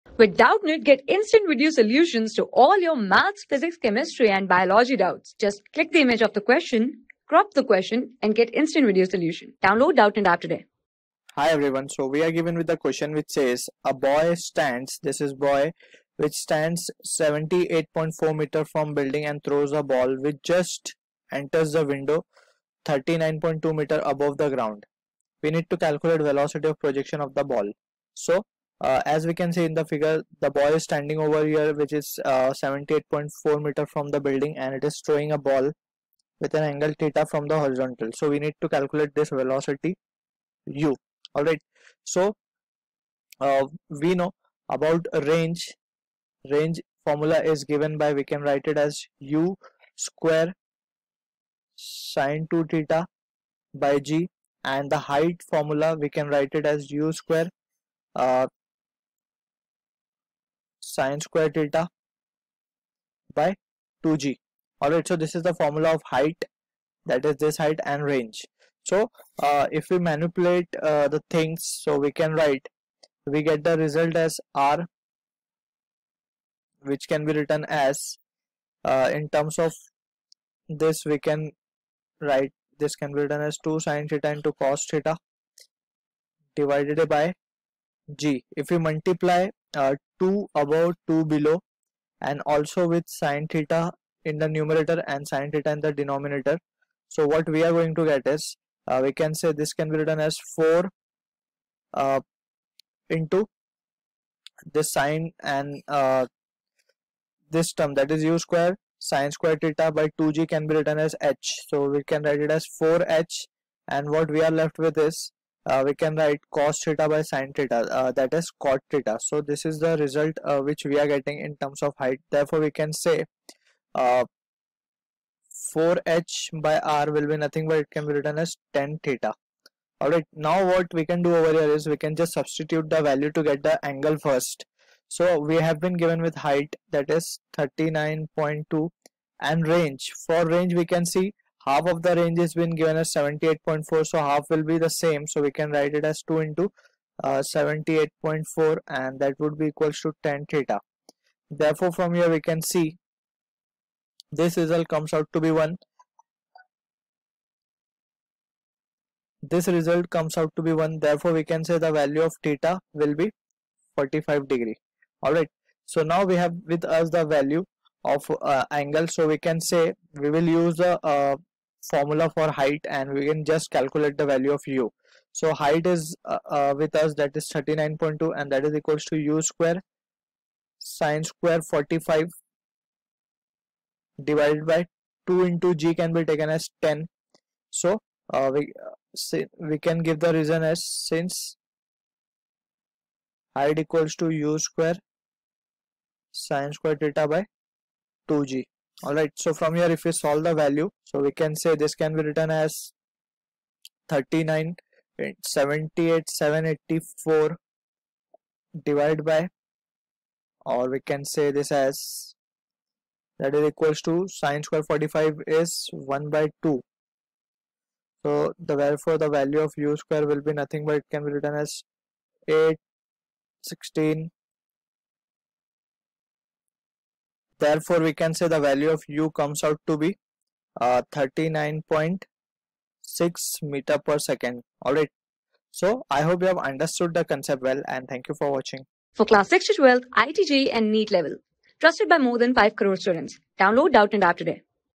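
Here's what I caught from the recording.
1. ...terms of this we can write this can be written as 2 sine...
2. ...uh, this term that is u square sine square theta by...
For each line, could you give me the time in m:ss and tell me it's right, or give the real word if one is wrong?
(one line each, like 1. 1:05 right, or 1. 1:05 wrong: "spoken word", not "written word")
1. 1:19 right
2. 1:45 right.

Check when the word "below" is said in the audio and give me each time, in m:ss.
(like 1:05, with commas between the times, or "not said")
1:31.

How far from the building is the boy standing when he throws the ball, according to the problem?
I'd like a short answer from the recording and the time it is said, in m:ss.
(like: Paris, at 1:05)
78.4 meters, at 0:17.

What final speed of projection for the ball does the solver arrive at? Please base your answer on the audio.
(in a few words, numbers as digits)
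39.6 m/s.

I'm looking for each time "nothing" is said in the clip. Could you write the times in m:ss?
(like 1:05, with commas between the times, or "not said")
2:07, 3:40.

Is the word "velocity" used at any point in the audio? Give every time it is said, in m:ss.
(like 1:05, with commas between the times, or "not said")
0:26, 0:39.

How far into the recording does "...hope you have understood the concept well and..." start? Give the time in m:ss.
3:56.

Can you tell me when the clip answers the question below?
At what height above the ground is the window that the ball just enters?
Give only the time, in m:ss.
0:22.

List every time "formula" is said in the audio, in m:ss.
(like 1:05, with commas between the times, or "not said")
0:47, 0:55, 1:05, 2:51.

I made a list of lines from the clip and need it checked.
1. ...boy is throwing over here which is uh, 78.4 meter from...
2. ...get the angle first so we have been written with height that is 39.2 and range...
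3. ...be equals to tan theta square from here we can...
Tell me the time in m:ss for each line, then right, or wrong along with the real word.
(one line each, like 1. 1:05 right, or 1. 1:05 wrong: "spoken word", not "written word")
1. 0:30 wrong: "standing", not "throwing"
2. 2:13 wrong: "given", not "written"
3. 2:29 wrong: "therefore", not "square".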